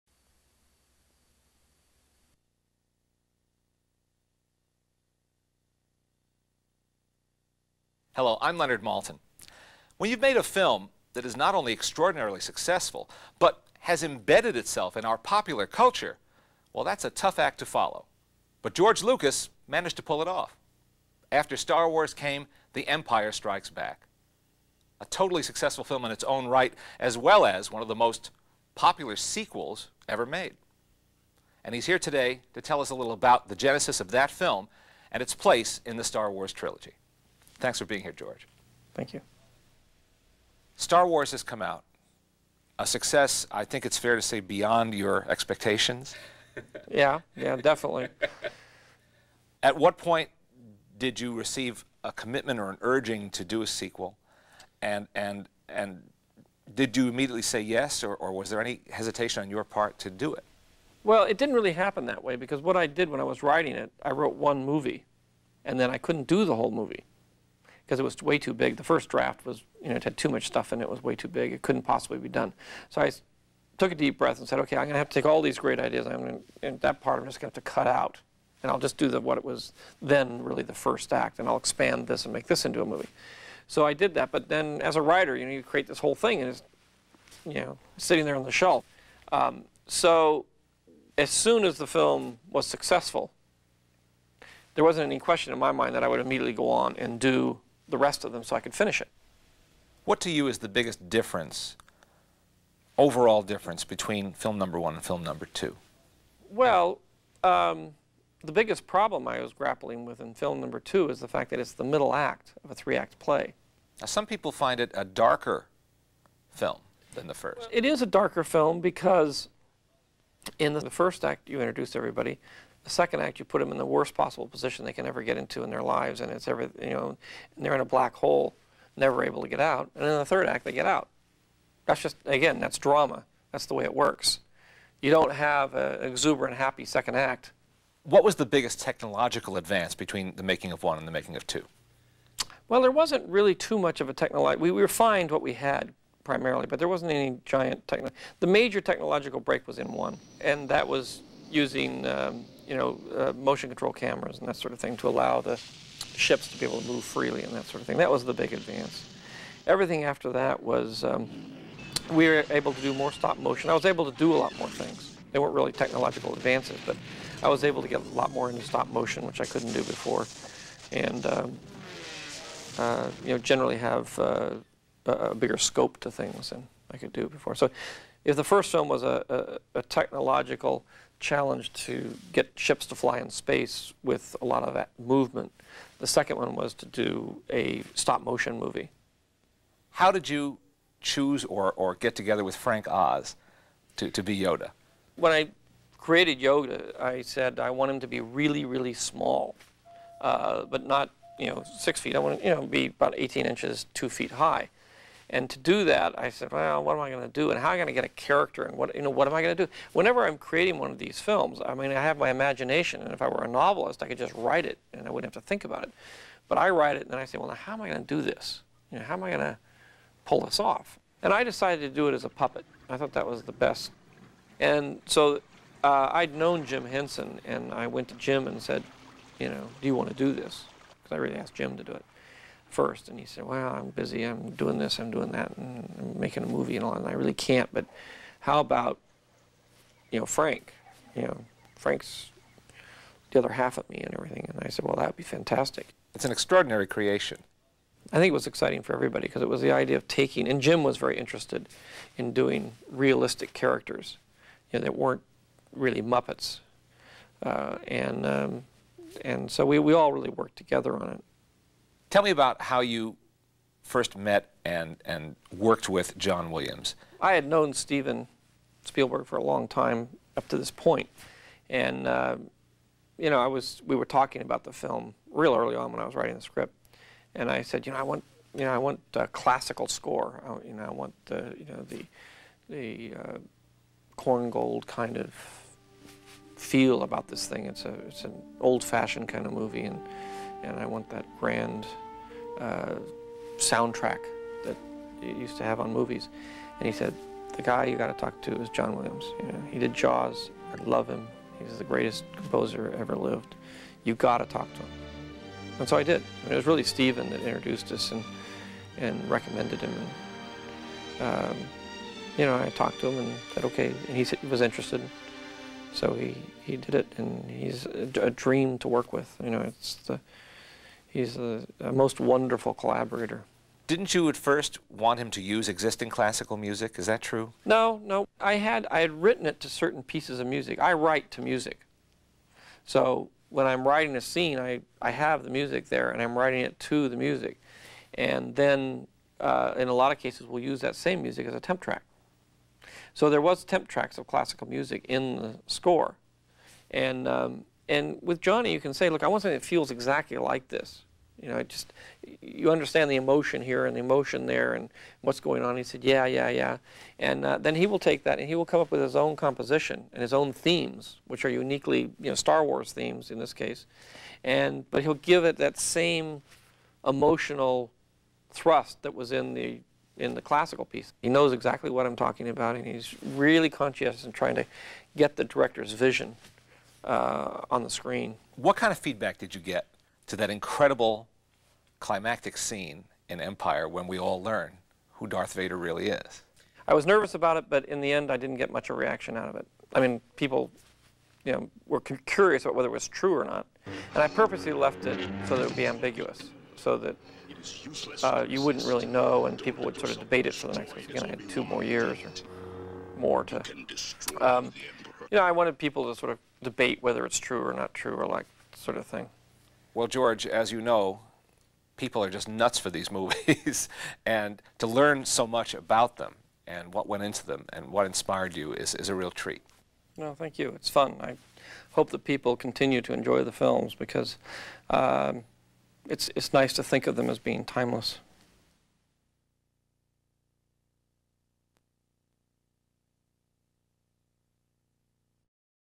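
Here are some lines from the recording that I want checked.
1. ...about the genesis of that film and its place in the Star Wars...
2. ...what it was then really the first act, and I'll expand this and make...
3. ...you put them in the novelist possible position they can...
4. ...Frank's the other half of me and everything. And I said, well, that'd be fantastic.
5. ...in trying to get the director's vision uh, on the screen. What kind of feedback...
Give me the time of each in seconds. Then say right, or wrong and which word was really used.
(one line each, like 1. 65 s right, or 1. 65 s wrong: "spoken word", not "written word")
1. 33 s right
2. 79 s right
3. 123 s wrong: "worst", not "novelist"
4. 241 s right
5. 374 s right.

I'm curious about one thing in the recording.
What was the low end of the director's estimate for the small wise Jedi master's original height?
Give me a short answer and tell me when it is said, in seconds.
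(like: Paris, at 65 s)
18 inches, at 203 s.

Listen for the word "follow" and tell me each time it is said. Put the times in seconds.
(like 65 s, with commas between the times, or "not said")
17 s.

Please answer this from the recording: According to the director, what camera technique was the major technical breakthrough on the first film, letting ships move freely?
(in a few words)
Motion control cameras.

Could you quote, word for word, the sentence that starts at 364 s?
And, but he'll give it that same emotional thrust that was in the in the classical piece.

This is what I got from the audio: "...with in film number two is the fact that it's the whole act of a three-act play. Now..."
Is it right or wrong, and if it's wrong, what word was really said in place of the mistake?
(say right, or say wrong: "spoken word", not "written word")
wrong: "middle", not "whole".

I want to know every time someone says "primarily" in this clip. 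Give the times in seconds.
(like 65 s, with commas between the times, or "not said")
146 s.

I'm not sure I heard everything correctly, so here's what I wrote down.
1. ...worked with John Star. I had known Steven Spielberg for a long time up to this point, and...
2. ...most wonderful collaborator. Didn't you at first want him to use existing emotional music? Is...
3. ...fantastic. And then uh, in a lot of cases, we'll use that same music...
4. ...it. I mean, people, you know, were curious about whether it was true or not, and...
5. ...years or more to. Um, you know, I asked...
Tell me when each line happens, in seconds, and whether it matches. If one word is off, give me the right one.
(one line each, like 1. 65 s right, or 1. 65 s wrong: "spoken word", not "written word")
1. 265 s wrong: "Williams", not "Star"
2. 321 s wrong: "classical", not "emotional"
3. 337 s wrong: "music", not "fantastic"
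4. 389 s right
5. 401 s wrong: "wanted", not "asked".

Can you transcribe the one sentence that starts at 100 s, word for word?
What to you is the biggest difference, overall difference, between film number one and film number two?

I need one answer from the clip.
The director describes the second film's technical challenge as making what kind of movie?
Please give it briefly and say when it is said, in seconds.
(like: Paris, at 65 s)
A stop motion movie, at 187 s.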